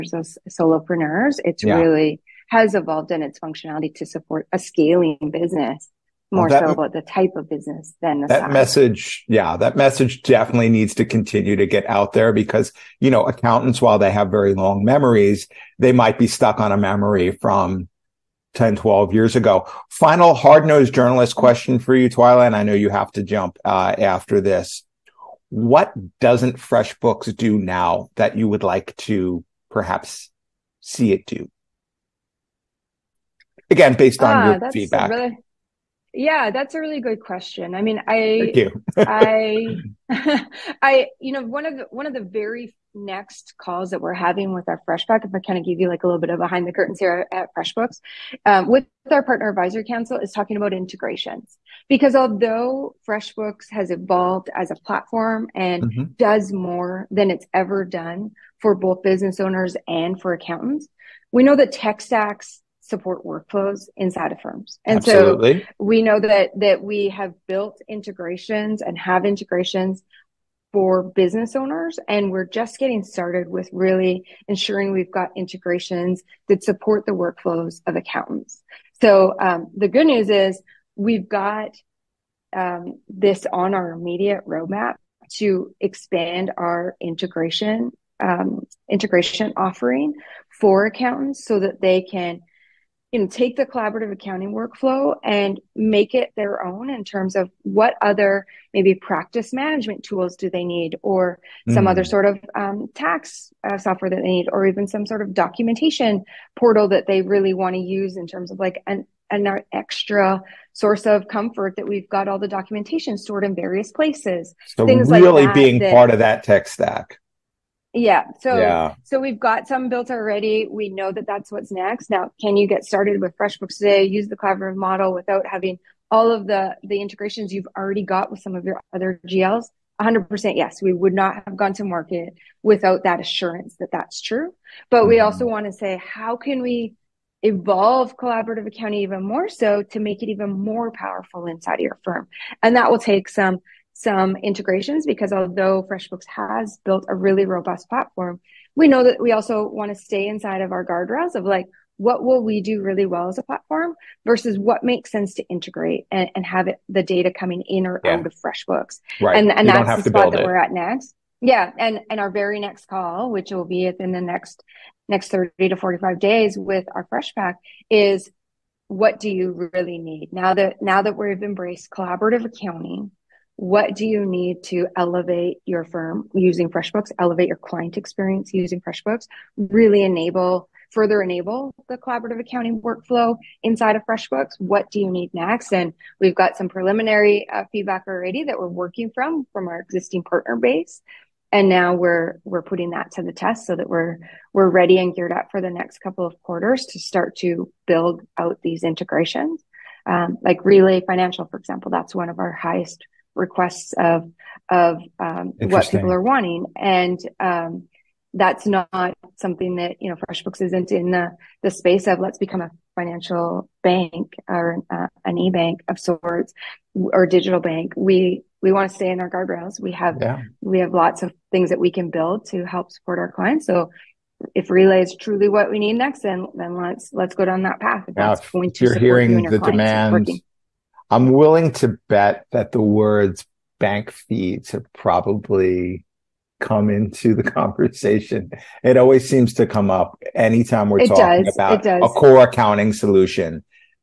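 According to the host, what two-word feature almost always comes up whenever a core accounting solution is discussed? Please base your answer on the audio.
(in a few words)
Bank feeds.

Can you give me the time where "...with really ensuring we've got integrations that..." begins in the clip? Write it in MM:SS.
01:13.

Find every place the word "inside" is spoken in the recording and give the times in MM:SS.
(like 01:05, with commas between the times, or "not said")
01:03, 02:21, 02:30, 03:03.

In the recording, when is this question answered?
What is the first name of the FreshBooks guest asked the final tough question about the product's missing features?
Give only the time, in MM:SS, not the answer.
00:22.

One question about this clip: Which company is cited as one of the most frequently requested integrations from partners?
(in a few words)
Relay Financial.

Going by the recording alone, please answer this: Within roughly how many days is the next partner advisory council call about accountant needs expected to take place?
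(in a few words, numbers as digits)
30 to 45 days.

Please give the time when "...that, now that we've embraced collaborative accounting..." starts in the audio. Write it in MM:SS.
02:50.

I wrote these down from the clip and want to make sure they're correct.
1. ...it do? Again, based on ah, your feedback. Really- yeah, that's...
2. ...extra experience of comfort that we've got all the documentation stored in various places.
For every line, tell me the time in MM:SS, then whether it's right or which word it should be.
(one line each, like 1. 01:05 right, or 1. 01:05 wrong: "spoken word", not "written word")
1. 00:31 right
2. 01:49 wrong: "source", not "experience".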